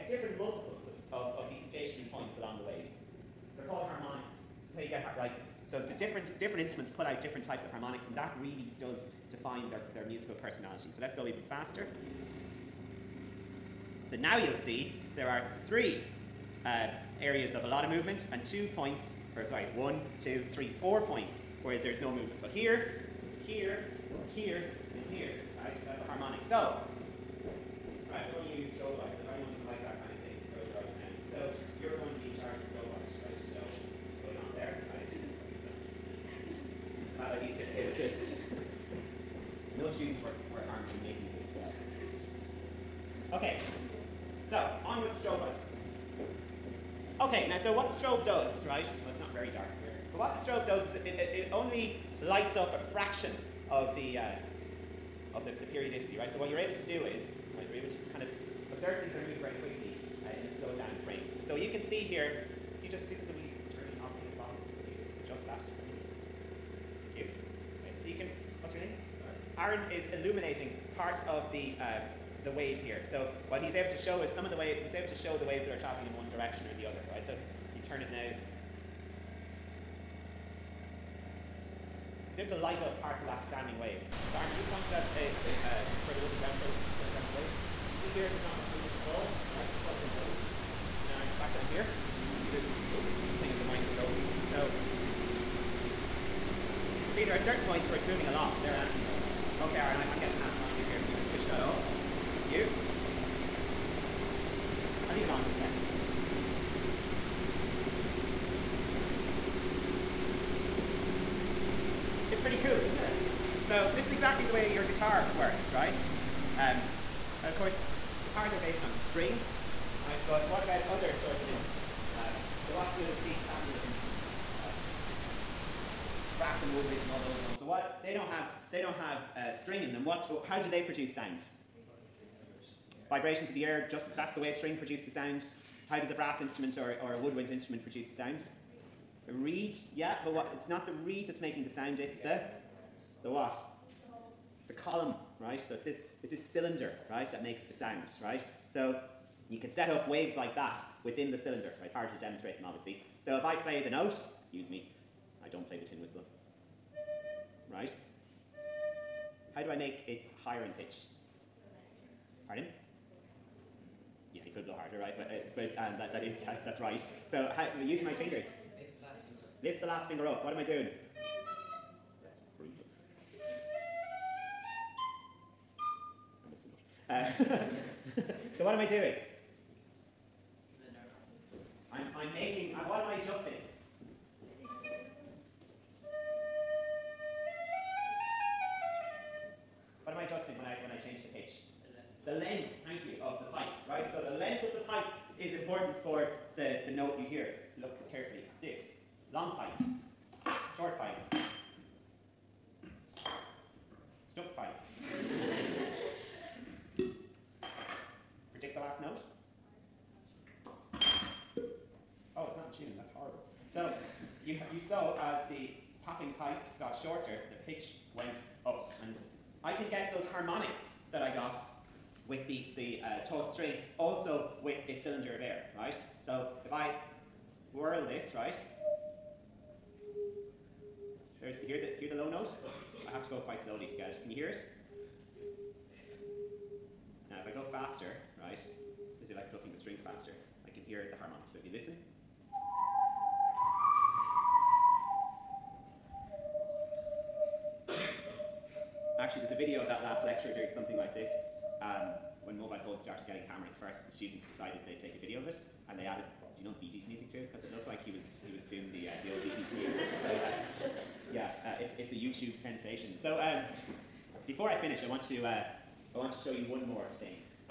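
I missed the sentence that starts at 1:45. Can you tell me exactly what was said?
I'll leave it on for a second.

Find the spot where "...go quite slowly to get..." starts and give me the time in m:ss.
3:53.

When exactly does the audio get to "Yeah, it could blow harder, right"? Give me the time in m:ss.
2:44.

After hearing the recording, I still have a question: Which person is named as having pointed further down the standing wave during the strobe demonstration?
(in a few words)
Armin.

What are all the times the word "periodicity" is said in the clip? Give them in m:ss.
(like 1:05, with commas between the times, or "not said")
0:55.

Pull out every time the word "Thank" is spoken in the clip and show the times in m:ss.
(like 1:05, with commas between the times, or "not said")
1:42.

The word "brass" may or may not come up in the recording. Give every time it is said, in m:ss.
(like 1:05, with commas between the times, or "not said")
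2:06, 2:16.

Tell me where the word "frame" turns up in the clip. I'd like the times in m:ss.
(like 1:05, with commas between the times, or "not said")
1:01.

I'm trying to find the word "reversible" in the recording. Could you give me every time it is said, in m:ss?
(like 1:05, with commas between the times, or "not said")
not said.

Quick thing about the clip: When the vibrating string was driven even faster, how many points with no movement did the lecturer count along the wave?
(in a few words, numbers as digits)
4.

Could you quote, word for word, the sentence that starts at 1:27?
So you see here, there's not much movement at all, right?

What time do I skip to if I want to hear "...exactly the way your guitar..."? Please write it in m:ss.
1:54.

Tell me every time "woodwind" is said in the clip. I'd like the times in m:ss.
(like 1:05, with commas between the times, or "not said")
2:06, 2:17.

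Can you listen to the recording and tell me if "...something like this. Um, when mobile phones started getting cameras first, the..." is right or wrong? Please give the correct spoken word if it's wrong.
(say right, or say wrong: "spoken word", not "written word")
right.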